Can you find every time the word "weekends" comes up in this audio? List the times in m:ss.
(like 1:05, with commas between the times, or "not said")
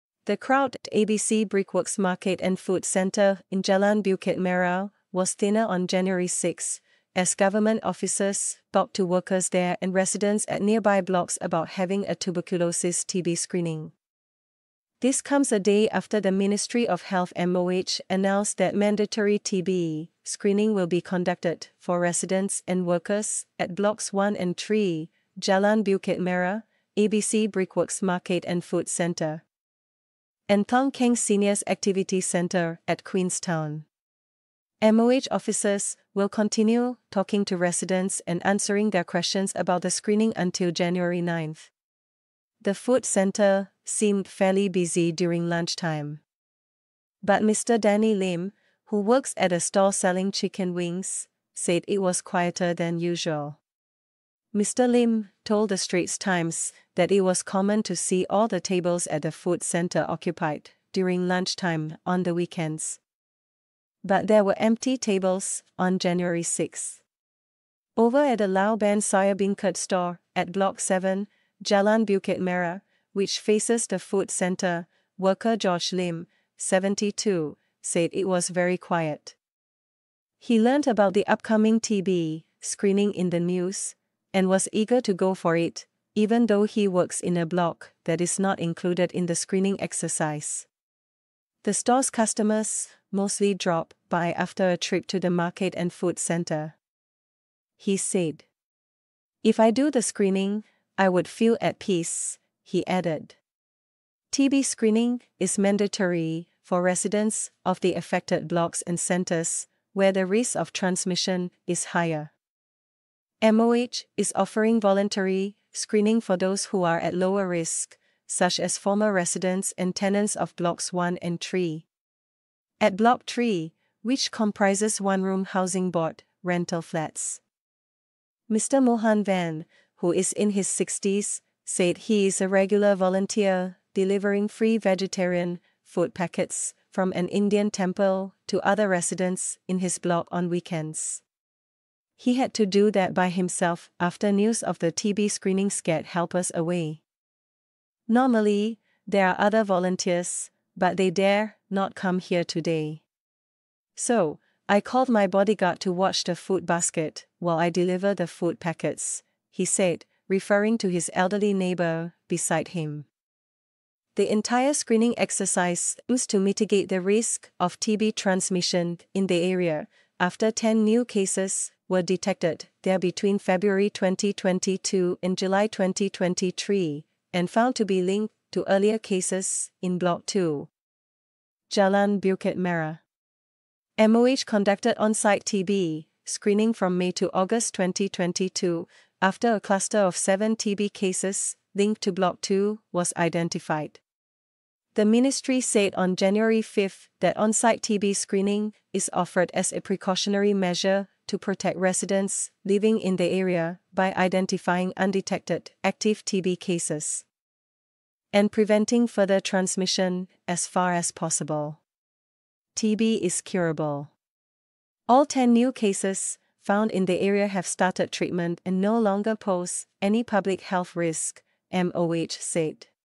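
1:02, 2:20.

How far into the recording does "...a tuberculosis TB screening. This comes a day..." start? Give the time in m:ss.
0:12.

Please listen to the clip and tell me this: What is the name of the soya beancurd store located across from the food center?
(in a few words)
Lao Ban.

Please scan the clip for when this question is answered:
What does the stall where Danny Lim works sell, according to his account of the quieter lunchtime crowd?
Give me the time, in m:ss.
0:50.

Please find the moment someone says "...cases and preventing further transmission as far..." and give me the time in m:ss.
3:26.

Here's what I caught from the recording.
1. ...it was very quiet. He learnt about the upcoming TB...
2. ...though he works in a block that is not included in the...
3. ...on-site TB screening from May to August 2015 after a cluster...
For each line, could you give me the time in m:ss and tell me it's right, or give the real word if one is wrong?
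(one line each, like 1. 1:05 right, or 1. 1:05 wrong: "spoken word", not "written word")
1. 1:18 right
2. 1:26 right
3. 3:05 wrong: "2022", not "2015".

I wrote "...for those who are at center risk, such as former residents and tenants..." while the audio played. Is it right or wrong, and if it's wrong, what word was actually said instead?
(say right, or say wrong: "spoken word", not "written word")
wrong: "lower", not "center".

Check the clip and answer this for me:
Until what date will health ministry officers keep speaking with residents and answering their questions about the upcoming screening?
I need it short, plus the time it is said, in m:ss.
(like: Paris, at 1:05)
January 9, at 0:40.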